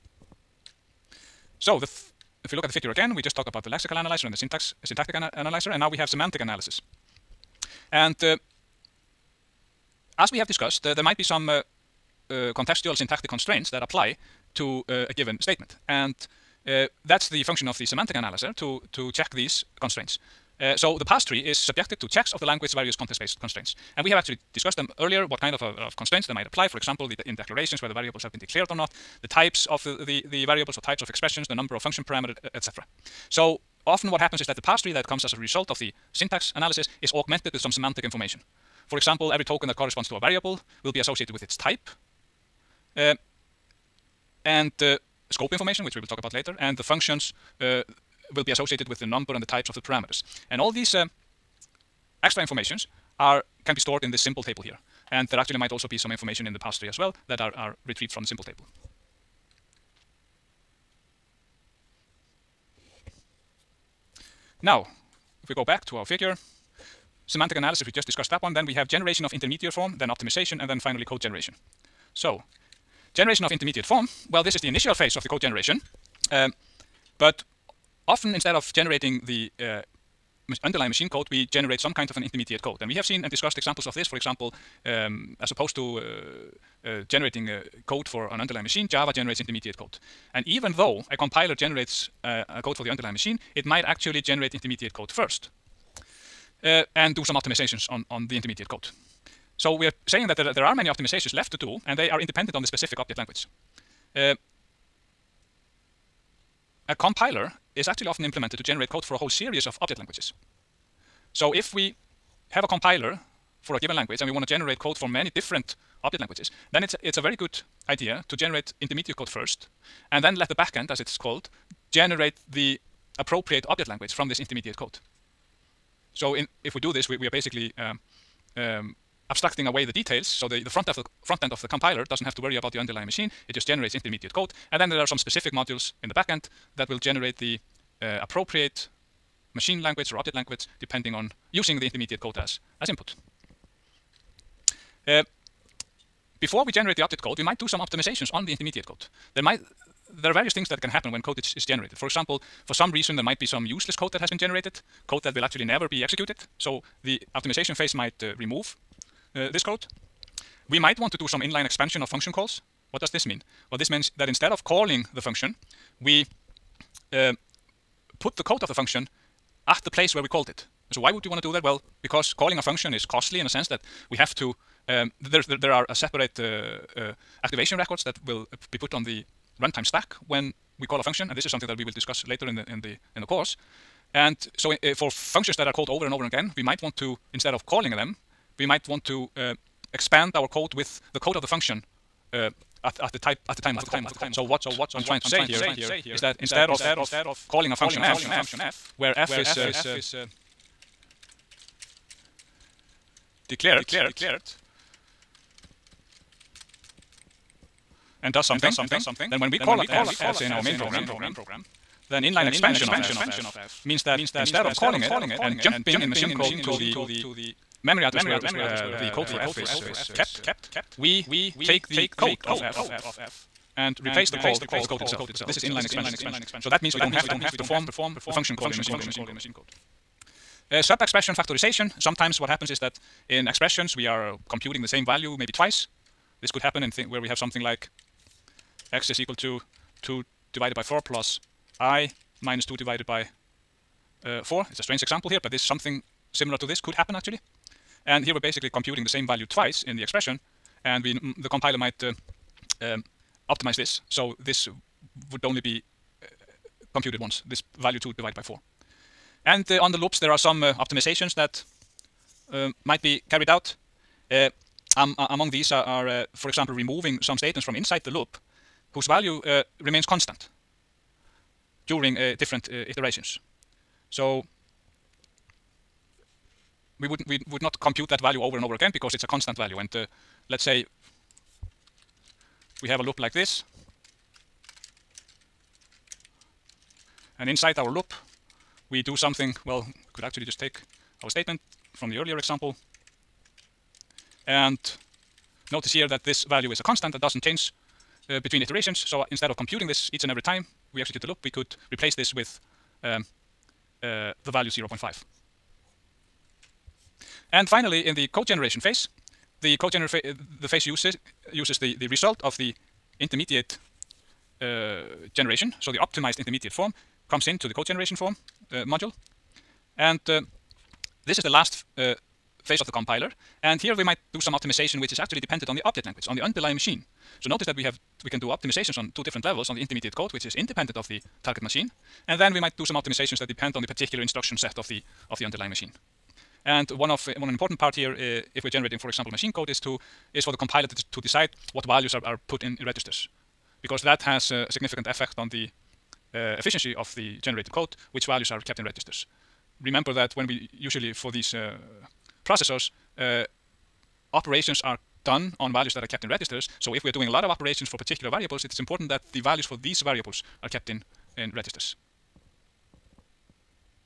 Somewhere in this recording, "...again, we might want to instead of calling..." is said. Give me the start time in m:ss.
3:06.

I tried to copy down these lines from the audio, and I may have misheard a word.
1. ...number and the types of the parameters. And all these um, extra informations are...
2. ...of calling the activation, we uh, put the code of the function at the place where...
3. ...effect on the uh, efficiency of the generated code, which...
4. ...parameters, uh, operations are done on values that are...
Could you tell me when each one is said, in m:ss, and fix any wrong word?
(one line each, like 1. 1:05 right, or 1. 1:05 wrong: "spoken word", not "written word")
1. 0:49 right
2. 2:44 wrong: "function", not "activation"
3. 5:45 right
4. 5:52 wrong: "processors", not "parameters".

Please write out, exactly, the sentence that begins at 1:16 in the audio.
Um, but often instead of generating the uh, underlying machine code, we generate some kind of an intermediate code.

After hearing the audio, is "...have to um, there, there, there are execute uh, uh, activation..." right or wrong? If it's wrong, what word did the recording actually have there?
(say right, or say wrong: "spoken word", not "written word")
wrong: "separate", not "execute".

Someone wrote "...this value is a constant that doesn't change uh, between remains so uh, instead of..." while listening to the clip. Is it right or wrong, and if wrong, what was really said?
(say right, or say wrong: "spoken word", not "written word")
wrong: "iterations", not "remains".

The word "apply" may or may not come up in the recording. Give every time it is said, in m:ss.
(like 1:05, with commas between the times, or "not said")
0:13, 0:26.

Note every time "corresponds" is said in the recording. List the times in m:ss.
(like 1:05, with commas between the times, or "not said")
0:39.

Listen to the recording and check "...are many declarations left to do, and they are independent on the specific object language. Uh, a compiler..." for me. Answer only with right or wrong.
wrong.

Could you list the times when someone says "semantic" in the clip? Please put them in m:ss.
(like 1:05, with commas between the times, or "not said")
0:06, 0:17, 0:37, 1:07.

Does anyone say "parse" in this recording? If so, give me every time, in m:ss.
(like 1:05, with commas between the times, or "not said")
0:21, 0:34, 0:56.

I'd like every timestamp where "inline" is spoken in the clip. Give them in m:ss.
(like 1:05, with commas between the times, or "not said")
2:41, 3:32, 3:45.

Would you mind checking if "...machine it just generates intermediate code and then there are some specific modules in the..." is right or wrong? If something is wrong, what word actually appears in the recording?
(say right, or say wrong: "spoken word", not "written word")
right.